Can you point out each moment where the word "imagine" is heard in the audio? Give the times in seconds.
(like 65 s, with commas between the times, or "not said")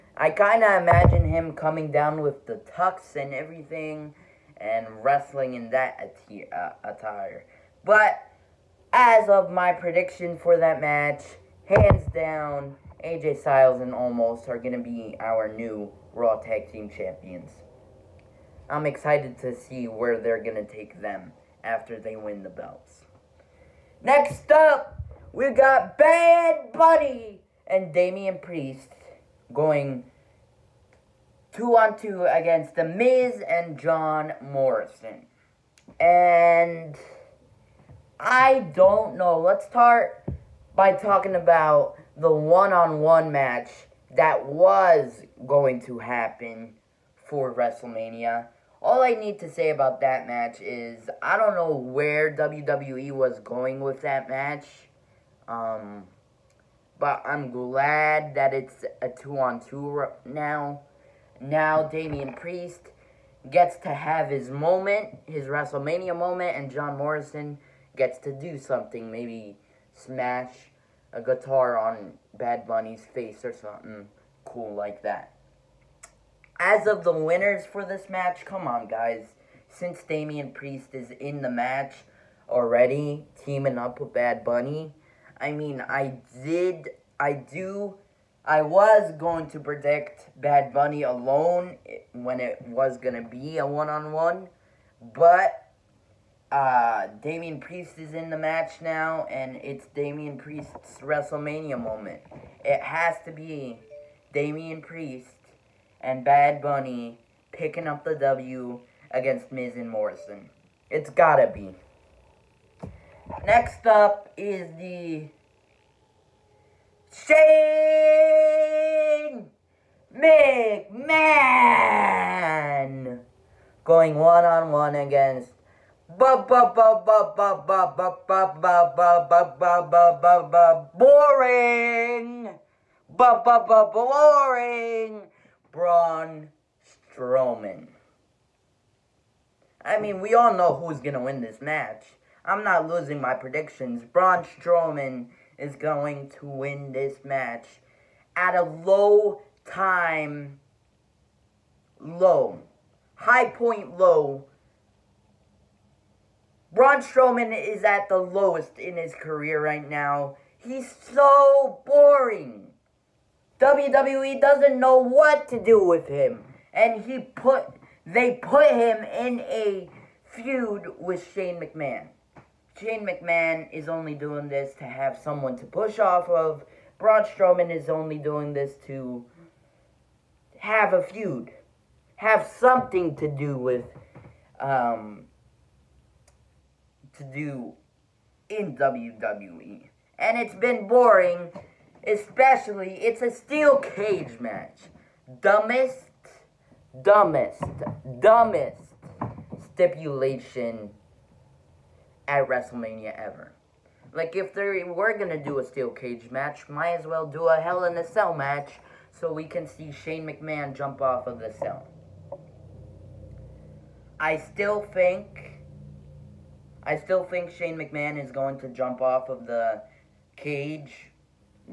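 0 s.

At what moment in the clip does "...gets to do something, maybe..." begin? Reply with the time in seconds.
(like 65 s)
67 s.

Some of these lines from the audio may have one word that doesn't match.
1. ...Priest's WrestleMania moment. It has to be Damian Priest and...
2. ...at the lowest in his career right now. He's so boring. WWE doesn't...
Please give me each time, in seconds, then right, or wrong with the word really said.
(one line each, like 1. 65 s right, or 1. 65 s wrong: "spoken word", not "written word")
1. 100 s right
2. 157 s right.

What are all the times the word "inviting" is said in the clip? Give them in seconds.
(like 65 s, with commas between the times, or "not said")
not said.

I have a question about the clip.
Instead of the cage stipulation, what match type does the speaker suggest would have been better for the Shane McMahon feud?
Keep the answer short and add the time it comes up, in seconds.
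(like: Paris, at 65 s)
Hell in a Cell, at 207 s.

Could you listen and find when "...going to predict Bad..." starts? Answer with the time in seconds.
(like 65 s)
89 s.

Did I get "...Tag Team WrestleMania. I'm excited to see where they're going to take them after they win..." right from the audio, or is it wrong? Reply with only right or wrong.
wrong.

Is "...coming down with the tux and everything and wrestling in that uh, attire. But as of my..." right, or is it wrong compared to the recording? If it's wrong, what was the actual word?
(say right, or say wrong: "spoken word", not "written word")
right.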